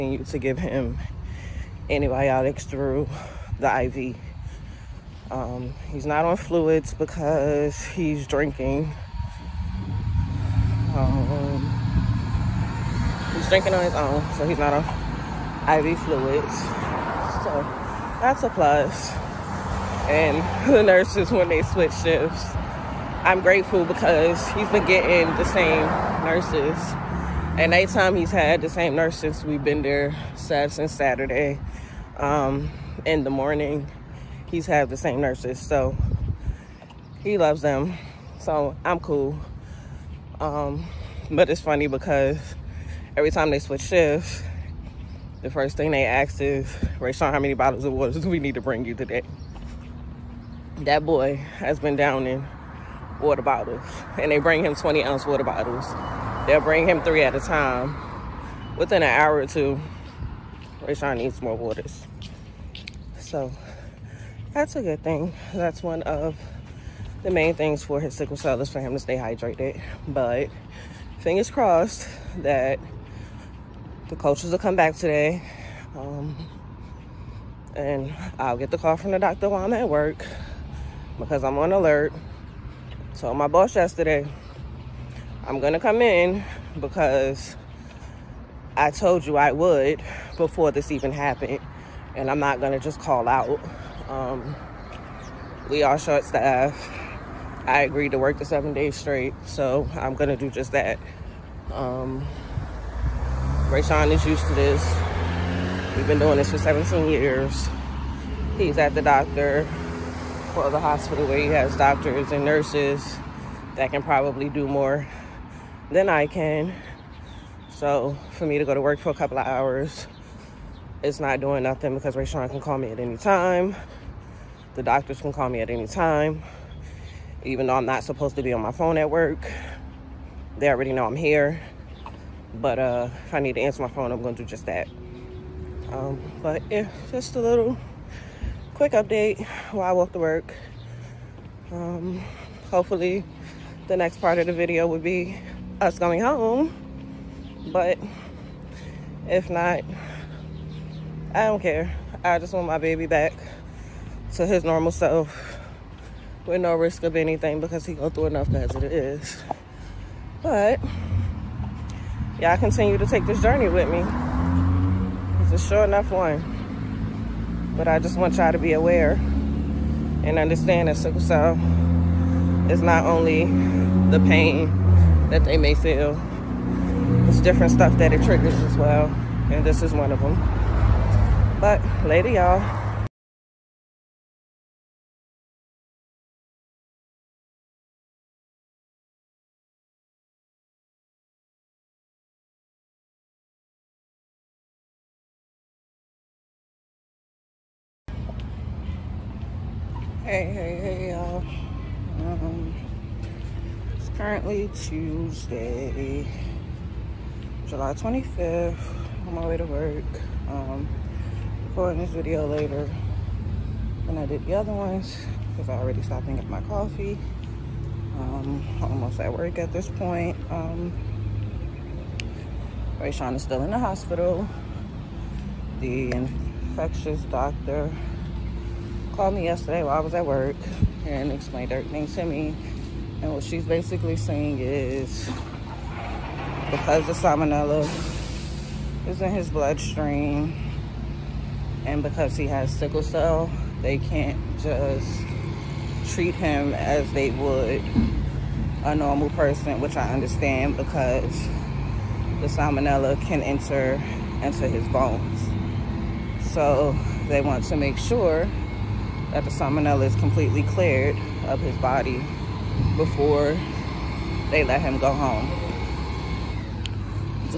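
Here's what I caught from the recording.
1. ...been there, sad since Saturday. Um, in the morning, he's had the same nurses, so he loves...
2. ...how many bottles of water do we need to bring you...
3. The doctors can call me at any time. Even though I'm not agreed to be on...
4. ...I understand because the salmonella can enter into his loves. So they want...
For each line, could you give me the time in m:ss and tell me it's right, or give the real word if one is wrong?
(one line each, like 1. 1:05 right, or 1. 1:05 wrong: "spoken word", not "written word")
1. 0:29 right
2. 0:47 right
3. 2:04 wrong: "supposed", not "agreed"
4. 4:09 wrong: "bones", not "loves".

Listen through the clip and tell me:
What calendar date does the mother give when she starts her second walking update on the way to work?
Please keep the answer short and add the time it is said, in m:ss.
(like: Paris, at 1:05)
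July 25th, at 3:27.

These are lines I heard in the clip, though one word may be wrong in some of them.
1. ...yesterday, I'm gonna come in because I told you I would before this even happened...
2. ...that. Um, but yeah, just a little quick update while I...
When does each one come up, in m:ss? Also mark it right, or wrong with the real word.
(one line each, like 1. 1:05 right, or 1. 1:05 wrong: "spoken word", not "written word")
1. 1:23 right
2. 2:14 right.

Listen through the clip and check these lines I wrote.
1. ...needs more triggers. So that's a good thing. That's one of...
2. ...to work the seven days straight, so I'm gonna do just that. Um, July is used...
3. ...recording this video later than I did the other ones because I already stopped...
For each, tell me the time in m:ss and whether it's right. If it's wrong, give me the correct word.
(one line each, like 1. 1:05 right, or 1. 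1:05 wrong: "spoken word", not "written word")
1. 1:01 wrong: "waters", not "triggers"
2. 1:38 wrong: "Rayshawn", not "July"
3. 3:31 right.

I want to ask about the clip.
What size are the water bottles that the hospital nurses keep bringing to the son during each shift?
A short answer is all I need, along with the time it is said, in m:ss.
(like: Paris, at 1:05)
20 ounce, at 0:54.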